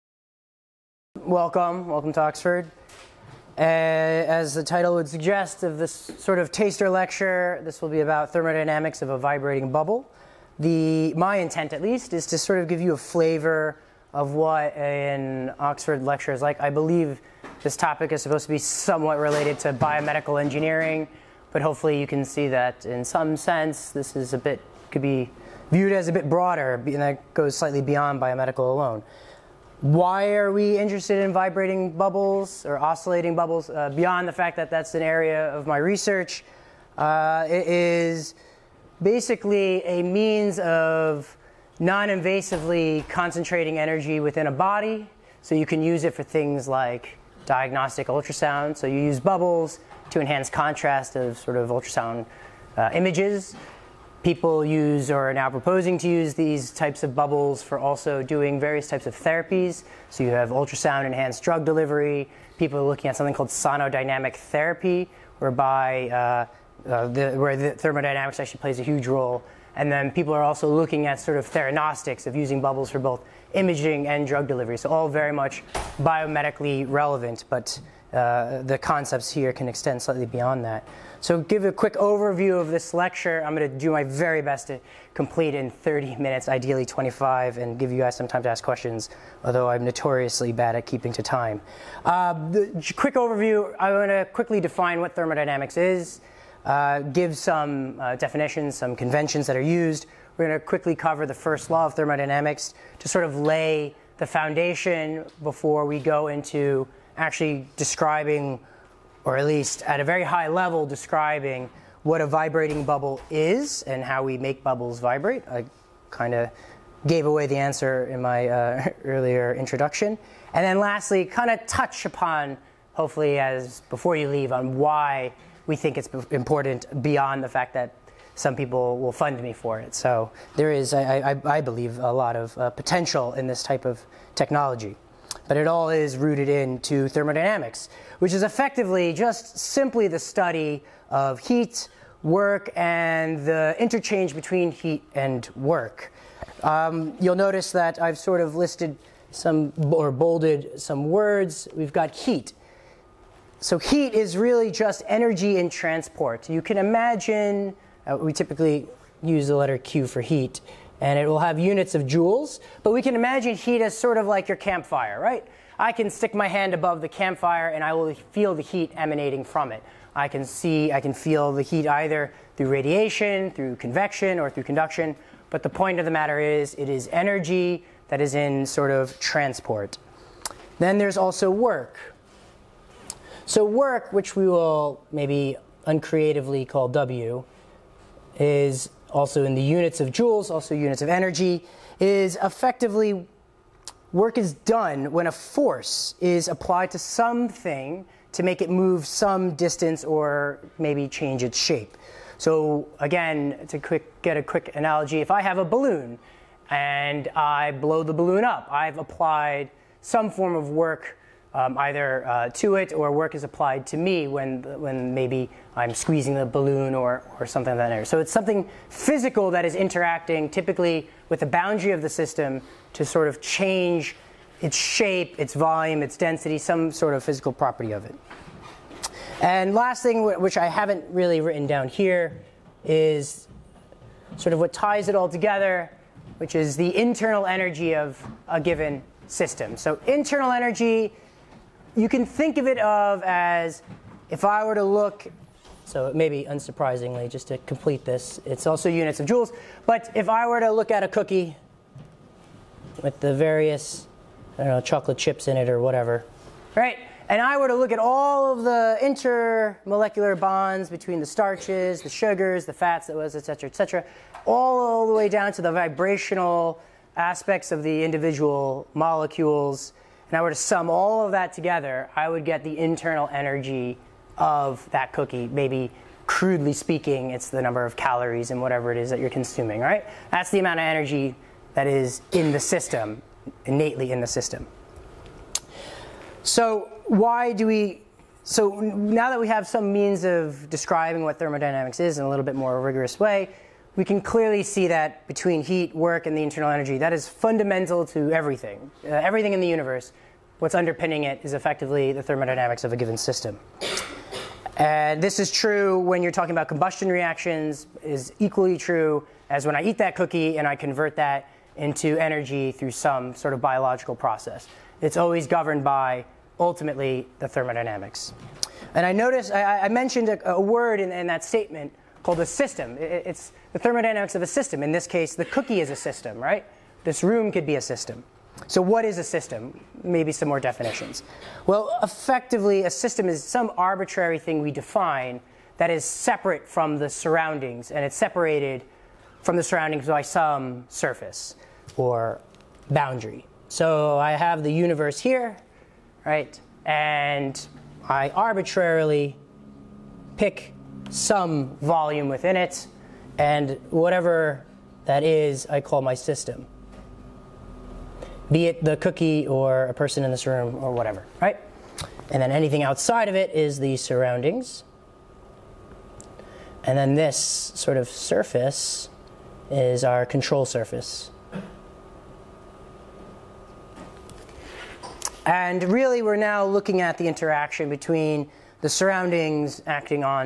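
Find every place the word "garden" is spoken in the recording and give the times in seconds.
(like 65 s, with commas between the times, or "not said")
not said.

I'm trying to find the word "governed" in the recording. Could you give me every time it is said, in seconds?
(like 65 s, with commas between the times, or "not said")
315 s.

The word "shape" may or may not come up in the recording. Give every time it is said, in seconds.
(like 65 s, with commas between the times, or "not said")
201 s, 224 s.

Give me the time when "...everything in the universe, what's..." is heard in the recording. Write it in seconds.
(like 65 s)
299 s.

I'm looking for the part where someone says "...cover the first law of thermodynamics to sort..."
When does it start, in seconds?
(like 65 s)
100 s.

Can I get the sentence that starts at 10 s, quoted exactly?
The, my intent, at least, is to sort of give you a flavor of what an Oxford lecture is like.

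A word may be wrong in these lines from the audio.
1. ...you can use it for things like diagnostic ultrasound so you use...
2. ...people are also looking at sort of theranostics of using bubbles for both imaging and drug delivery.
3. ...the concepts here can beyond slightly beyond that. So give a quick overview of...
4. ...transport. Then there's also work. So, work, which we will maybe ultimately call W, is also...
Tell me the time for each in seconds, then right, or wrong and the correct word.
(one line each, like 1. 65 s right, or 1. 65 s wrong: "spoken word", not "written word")
1. 45 s right
2. 70 s right
3. 78 s wrong: "extend", not "beyond"
4. 179 s wrong: "uncreatively", not "ultimately".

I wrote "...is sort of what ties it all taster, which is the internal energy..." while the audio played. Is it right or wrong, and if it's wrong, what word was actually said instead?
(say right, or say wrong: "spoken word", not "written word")
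wrong: "together", not "taster".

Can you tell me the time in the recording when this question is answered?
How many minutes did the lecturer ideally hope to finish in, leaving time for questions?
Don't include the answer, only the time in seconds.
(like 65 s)
86 s.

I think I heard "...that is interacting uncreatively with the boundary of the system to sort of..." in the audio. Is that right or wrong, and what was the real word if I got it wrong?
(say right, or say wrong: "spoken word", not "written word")
wrong: "typically", not "uncreatively".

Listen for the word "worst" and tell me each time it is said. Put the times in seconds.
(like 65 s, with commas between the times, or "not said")
not said.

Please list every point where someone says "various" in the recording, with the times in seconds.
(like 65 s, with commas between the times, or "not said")
58 s, 253 s.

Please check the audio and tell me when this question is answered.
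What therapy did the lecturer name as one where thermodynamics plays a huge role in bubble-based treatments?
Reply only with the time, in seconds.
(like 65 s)
63 s.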